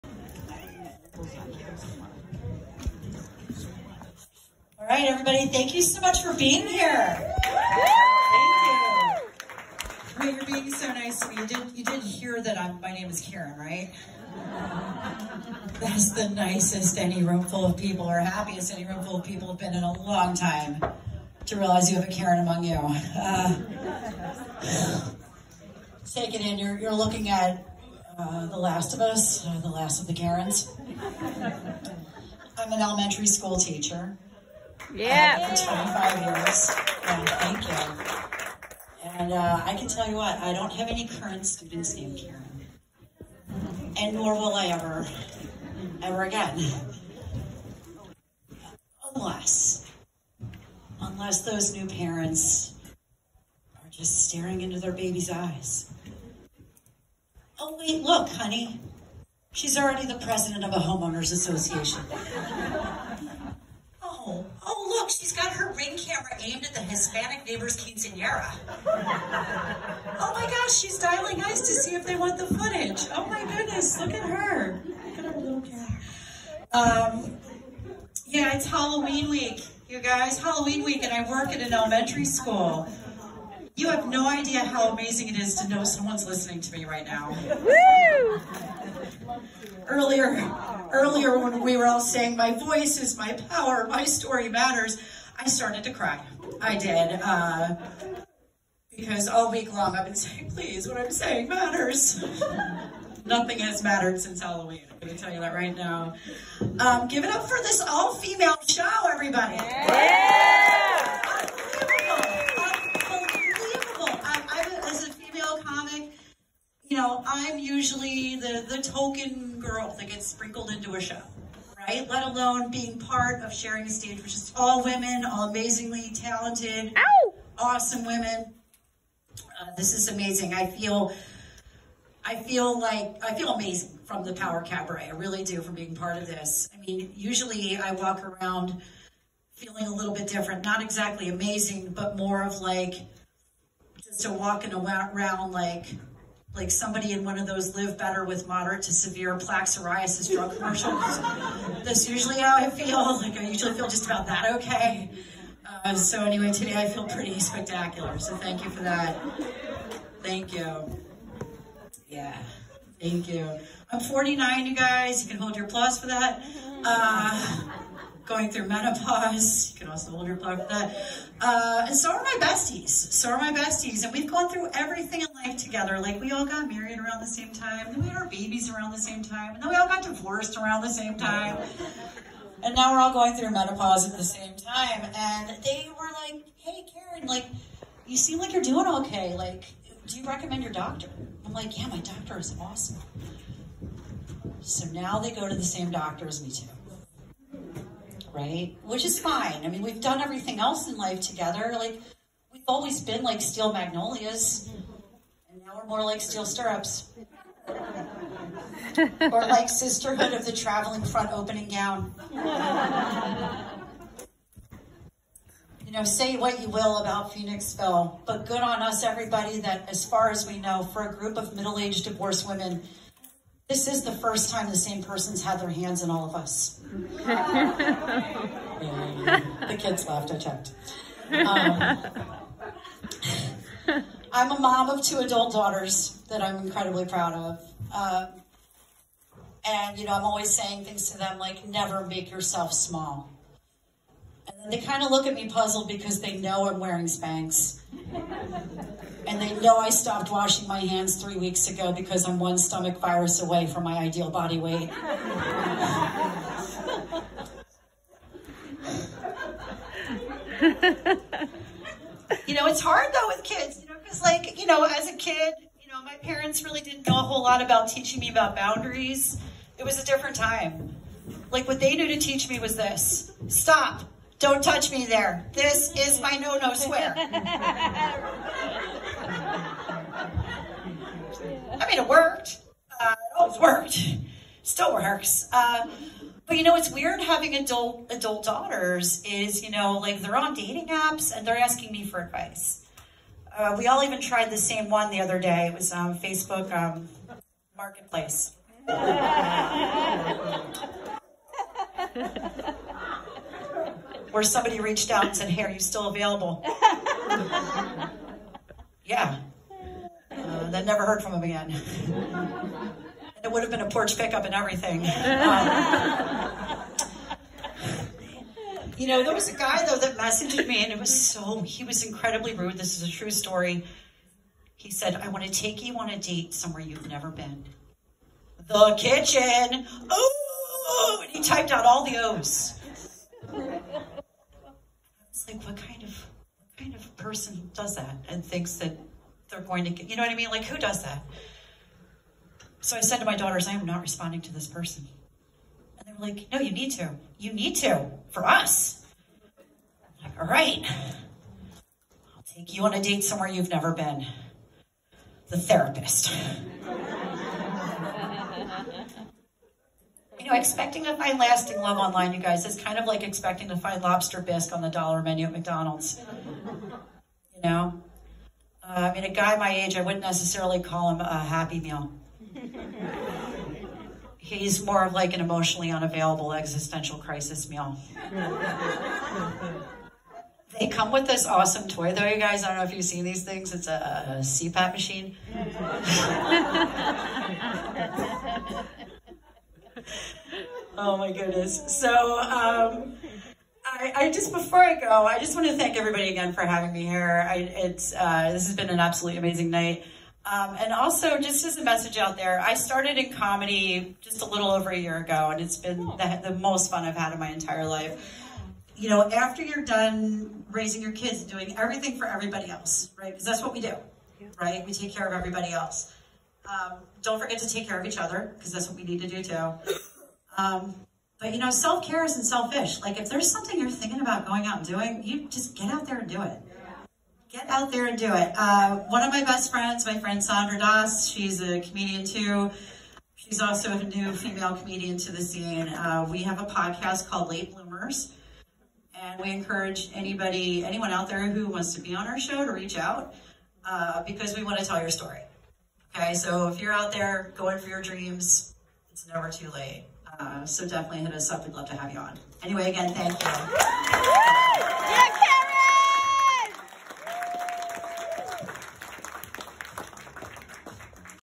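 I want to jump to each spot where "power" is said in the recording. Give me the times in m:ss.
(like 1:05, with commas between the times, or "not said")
1:33, 2:14.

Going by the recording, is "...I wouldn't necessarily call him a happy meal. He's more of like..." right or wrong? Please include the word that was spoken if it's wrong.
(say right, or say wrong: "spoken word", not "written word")
right.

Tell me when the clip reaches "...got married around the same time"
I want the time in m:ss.
2:56.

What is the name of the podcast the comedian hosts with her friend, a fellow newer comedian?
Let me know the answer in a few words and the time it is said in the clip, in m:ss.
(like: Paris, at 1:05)
Late Bloomers, at 7:17.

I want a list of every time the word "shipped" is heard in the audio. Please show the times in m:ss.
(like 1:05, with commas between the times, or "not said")
not said.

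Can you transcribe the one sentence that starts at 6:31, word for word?
So um, I, I, just, before I go, I just want to thank everybody again for having me here.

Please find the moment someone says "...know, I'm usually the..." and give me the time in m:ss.
1:56.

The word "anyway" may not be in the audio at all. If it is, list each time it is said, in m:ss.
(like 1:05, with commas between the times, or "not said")
2:36, 7:32.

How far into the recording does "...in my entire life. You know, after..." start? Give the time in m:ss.
6:47.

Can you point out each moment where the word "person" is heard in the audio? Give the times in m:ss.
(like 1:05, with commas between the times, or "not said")
3:45, 5:37, 5:44.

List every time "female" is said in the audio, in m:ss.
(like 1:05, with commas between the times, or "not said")
1:47, 7:14.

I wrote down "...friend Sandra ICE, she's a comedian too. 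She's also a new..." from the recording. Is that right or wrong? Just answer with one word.
wrong.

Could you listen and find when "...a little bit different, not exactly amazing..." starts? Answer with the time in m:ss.
2:19.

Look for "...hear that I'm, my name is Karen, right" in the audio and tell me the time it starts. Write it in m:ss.
0:12.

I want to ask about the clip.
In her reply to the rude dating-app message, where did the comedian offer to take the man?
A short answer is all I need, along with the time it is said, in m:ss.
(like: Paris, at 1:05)
The therapist, at 5:55.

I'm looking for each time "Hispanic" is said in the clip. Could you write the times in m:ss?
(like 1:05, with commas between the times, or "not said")
1:06.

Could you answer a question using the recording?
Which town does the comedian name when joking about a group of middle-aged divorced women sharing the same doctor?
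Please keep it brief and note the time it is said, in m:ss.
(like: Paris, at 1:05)
Phoenixville, at 3:37.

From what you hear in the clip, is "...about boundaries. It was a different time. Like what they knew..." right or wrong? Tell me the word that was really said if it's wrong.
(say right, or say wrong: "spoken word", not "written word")
right.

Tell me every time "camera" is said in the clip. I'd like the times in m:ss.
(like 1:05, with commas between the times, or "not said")
1:05, 1:15.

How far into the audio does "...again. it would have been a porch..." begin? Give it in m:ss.
5:11.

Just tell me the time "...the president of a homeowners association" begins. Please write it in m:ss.
1:00.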